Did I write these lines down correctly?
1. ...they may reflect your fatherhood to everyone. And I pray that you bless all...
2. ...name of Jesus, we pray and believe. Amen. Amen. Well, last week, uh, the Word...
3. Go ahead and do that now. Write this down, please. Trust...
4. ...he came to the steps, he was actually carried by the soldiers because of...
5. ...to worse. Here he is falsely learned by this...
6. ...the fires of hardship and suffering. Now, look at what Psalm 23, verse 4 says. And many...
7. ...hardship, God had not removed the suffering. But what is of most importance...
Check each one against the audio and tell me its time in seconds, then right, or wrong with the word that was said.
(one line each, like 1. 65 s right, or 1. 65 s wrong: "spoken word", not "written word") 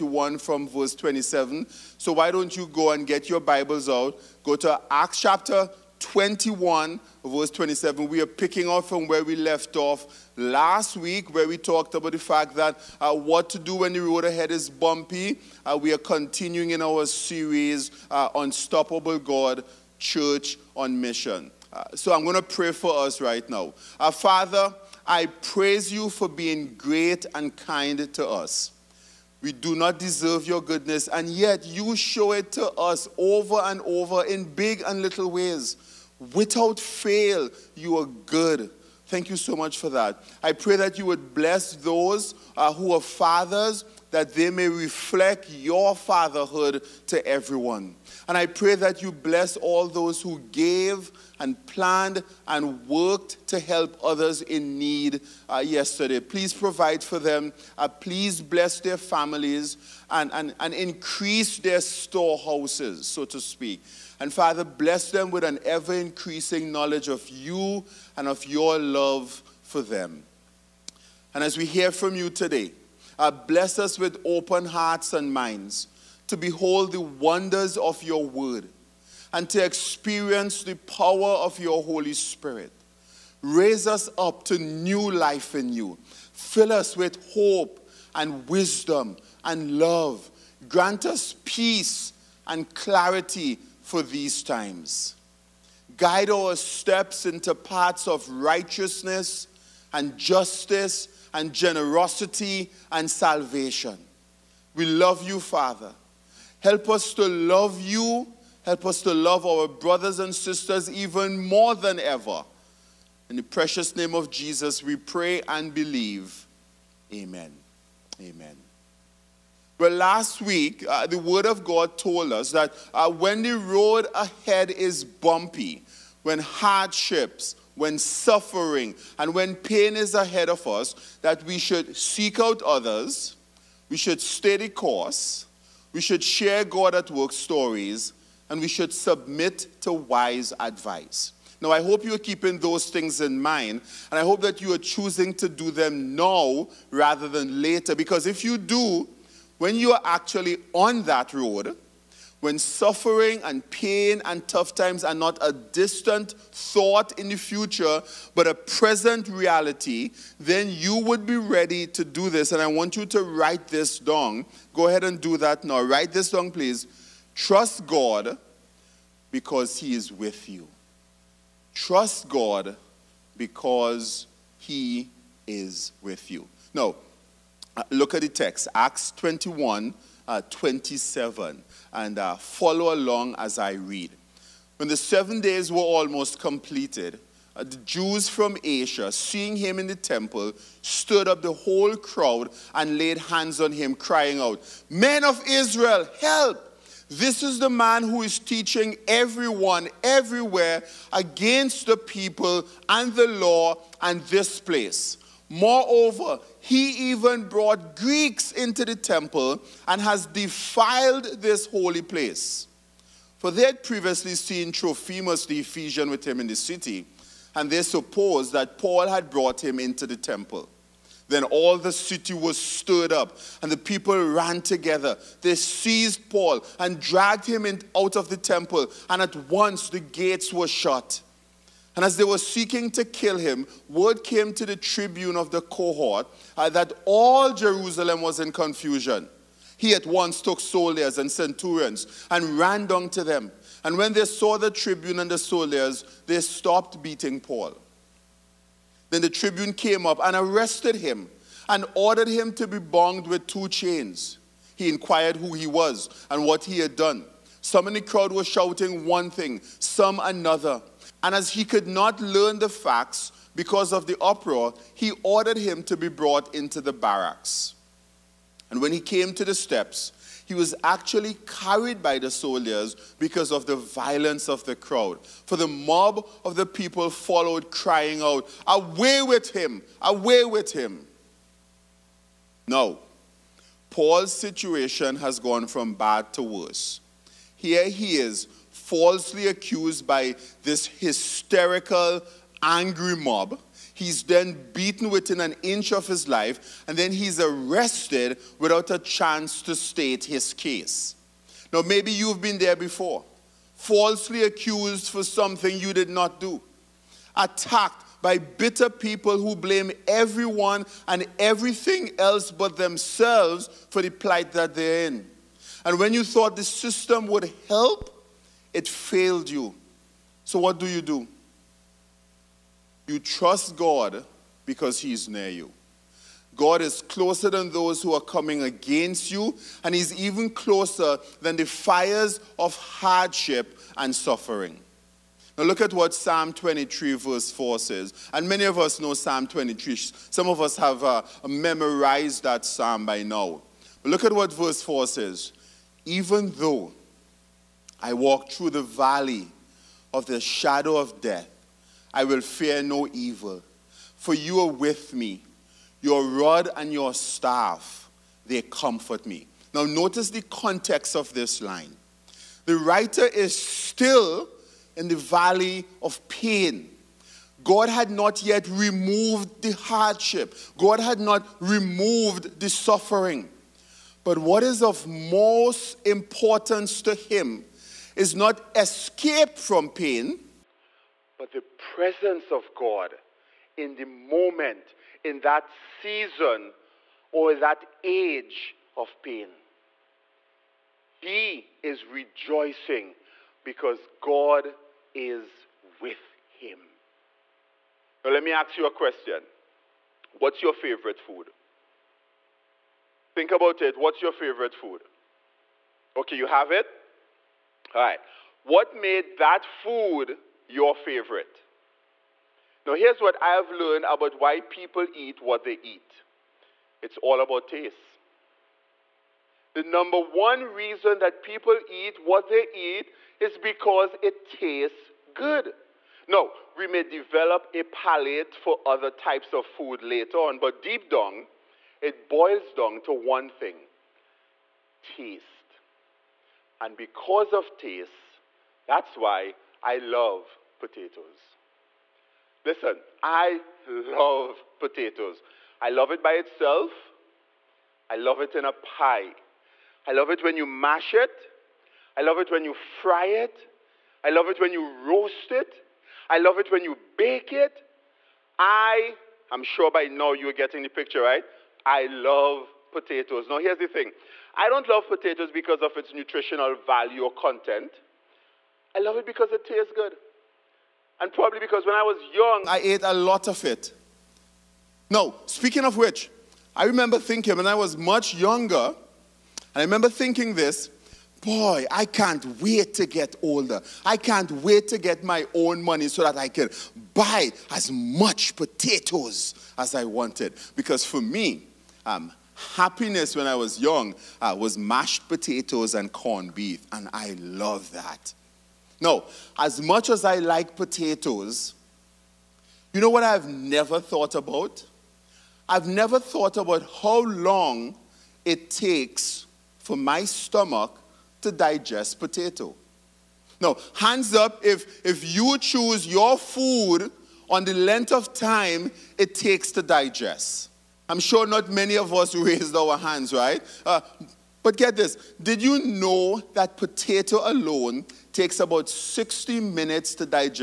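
1. 44 s right
2. 113 s right
3. 164 s right
4. 268 s right
5. 286 s wrong: "accused", not "learned"
6. 331 s right
7. 369 s right.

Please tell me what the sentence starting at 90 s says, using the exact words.
Grant us peace and clarity for these times.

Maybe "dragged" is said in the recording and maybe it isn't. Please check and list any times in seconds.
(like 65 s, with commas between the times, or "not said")
226 s.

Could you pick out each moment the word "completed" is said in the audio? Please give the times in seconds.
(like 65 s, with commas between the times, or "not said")
186 s.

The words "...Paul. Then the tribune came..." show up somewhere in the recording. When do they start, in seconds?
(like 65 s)
247 s.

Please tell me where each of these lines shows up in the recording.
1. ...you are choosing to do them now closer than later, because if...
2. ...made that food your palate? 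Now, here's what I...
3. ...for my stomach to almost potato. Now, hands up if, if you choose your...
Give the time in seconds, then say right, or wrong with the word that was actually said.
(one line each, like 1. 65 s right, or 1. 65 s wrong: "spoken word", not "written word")
1. 144 s wrong: "rather", not "closer"
2. 408 s wrong: "favorite", not "palate"
3. 509 s wrong: "digest", not "almost".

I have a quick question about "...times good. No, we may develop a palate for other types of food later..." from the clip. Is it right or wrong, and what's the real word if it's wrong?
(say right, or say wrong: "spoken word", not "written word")
wrong: "tastes", not "times".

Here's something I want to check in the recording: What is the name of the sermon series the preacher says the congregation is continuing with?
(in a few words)
Unstoppable God, Church on Mission.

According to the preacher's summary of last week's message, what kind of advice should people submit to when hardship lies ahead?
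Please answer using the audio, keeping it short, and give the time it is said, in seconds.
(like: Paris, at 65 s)
Wise advice, at 139 s.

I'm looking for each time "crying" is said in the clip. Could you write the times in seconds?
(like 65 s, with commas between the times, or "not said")
193 s, 277 s.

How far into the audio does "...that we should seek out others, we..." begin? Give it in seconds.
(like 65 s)
131 s.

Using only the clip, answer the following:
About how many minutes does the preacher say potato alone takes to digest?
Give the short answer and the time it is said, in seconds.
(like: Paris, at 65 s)
60, at 528 s.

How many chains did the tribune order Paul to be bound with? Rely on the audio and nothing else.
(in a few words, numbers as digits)
2.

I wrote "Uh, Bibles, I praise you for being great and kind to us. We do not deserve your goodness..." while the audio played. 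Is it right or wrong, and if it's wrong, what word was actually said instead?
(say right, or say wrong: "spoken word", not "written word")
wrong: "Father", not "Bibles".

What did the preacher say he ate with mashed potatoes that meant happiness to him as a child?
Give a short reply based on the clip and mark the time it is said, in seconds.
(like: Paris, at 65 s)
Corned beef, at 496 s.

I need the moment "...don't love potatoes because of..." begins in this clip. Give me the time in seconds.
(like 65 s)
464 s.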